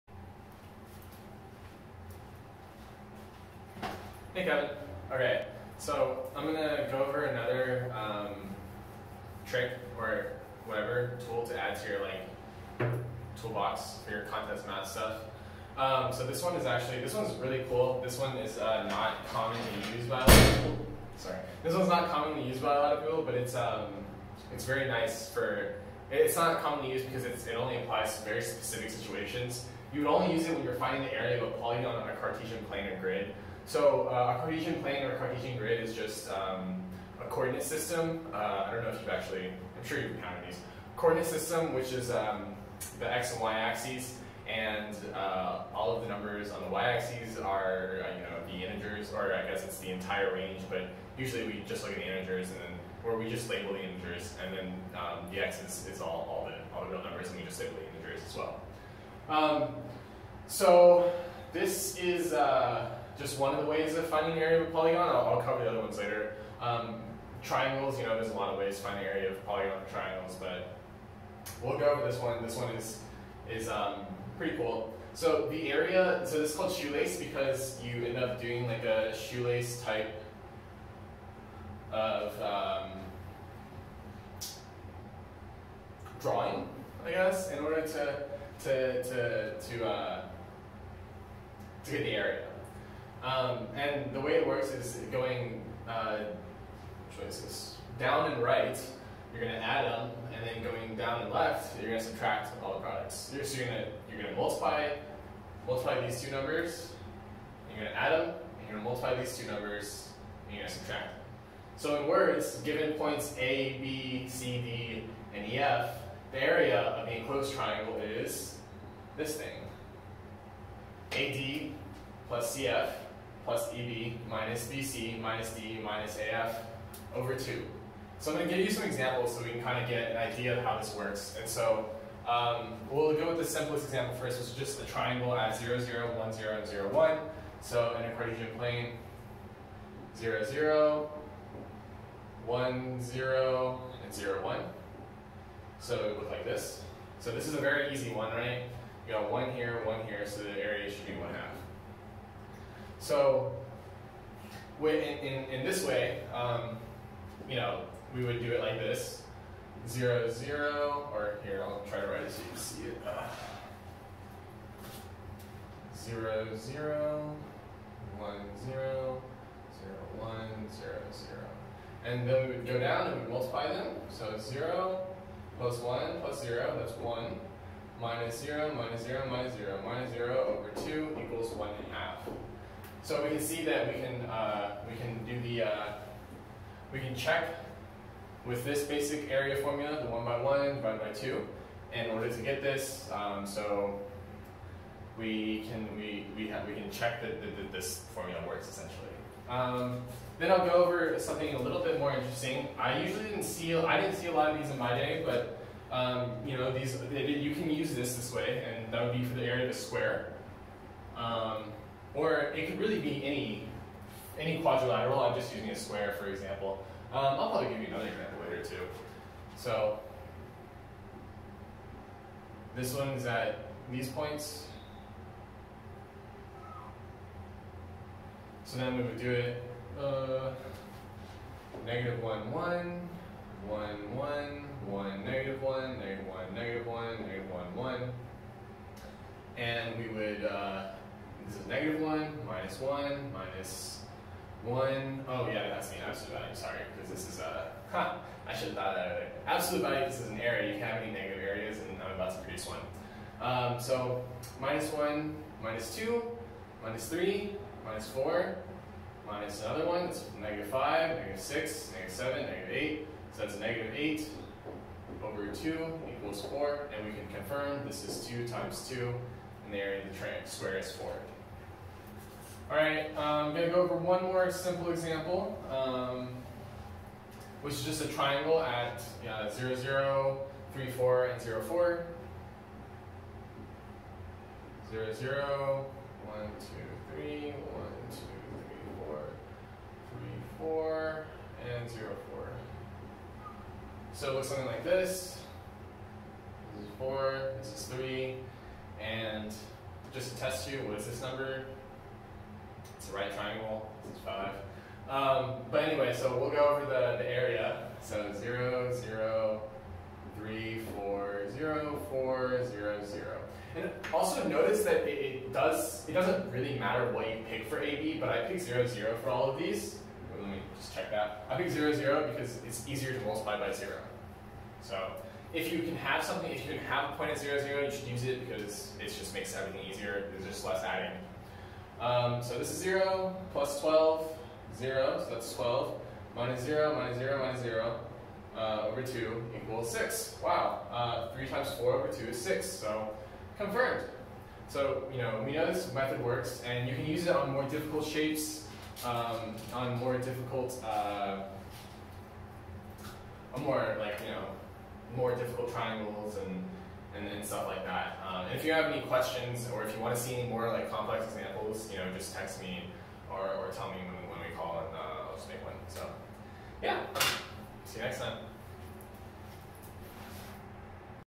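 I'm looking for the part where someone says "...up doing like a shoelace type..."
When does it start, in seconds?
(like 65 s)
78 s.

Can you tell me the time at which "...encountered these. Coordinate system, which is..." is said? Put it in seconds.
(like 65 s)
40 s.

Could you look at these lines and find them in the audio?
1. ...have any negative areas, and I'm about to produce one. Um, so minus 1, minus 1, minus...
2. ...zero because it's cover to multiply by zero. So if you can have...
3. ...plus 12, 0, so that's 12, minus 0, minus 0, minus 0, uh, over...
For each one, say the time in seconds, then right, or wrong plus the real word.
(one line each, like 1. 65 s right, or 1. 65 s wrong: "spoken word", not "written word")
1. 250 s wrong: "2", not "1"
2. 321 s wrong: "easier", not "cover"
3. 333 s right.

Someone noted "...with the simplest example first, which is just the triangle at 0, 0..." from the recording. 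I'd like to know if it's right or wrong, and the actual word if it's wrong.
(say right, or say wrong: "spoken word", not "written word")
right.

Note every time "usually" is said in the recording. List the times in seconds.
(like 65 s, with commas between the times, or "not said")
51 s, 203 s.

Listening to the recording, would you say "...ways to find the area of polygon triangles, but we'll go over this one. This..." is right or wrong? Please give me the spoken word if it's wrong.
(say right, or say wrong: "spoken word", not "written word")
right.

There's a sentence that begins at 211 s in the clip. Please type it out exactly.
Um, or it could really be any, any quadrilateral.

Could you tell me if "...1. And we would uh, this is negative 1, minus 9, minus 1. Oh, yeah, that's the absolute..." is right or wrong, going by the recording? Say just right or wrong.
wrong.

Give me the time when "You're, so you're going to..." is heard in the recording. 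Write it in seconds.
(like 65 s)
103 s.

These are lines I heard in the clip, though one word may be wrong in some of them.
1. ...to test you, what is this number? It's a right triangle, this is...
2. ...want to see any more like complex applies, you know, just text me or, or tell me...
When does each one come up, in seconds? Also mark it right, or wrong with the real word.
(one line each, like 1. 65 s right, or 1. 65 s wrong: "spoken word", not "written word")
1. 300 s right
2. 360 s wrong: "examples", not "applies".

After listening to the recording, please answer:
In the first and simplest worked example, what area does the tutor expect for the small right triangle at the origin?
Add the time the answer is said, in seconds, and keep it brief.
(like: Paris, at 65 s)
1/2, at 151 s.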